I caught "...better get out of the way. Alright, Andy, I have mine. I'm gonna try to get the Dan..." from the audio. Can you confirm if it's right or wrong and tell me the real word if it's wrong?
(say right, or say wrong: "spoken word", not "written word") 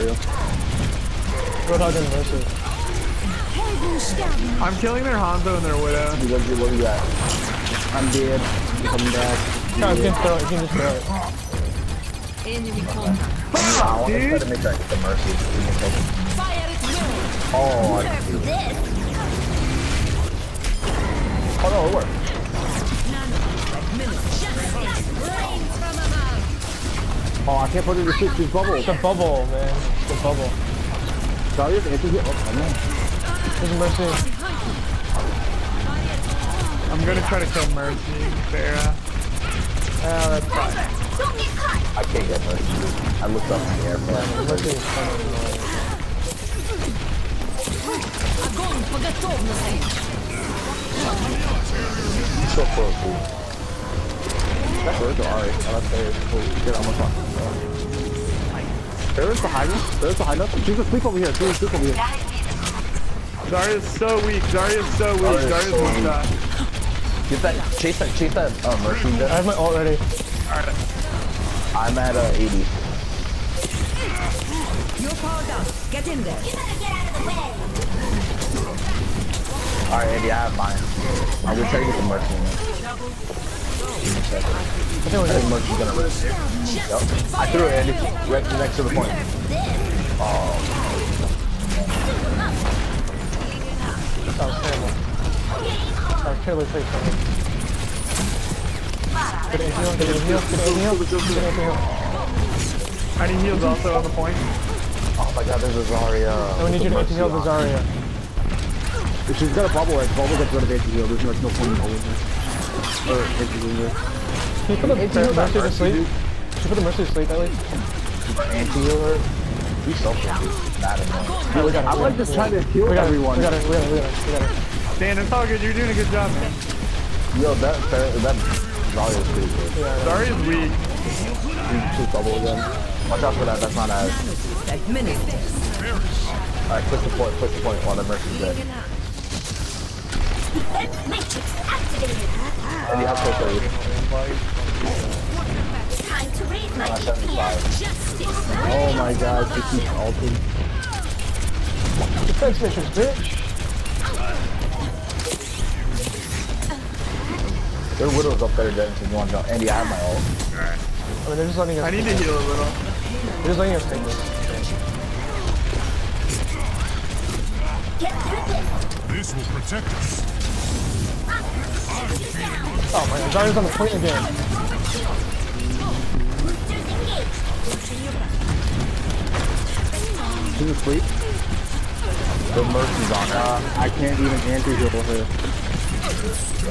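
wrong: "Mercy", not "Dan".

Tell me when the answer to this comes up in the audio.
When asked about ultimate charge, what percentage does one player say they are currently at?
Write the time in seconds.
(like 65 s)
72 s.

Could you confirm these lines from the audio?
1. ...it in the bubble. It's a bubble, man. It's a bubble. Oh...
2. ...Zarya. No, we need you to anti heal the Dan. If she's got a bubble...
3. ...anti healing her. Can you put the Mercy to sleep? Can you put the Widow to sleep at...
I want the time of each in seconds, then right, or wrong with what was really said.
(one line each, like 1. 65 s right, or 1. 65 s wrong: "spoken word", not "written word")
1. 27 s right
2. 105 s wrong: "Zarya", not "Dan"
3. 113 s wrong: "Mercy", not "Widow".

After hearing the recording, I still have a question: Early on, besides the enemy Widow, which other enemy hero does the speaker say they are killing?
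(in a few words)
Hanzo.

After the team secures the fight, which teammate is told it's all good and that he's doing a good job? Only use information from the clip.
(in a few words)
Dan.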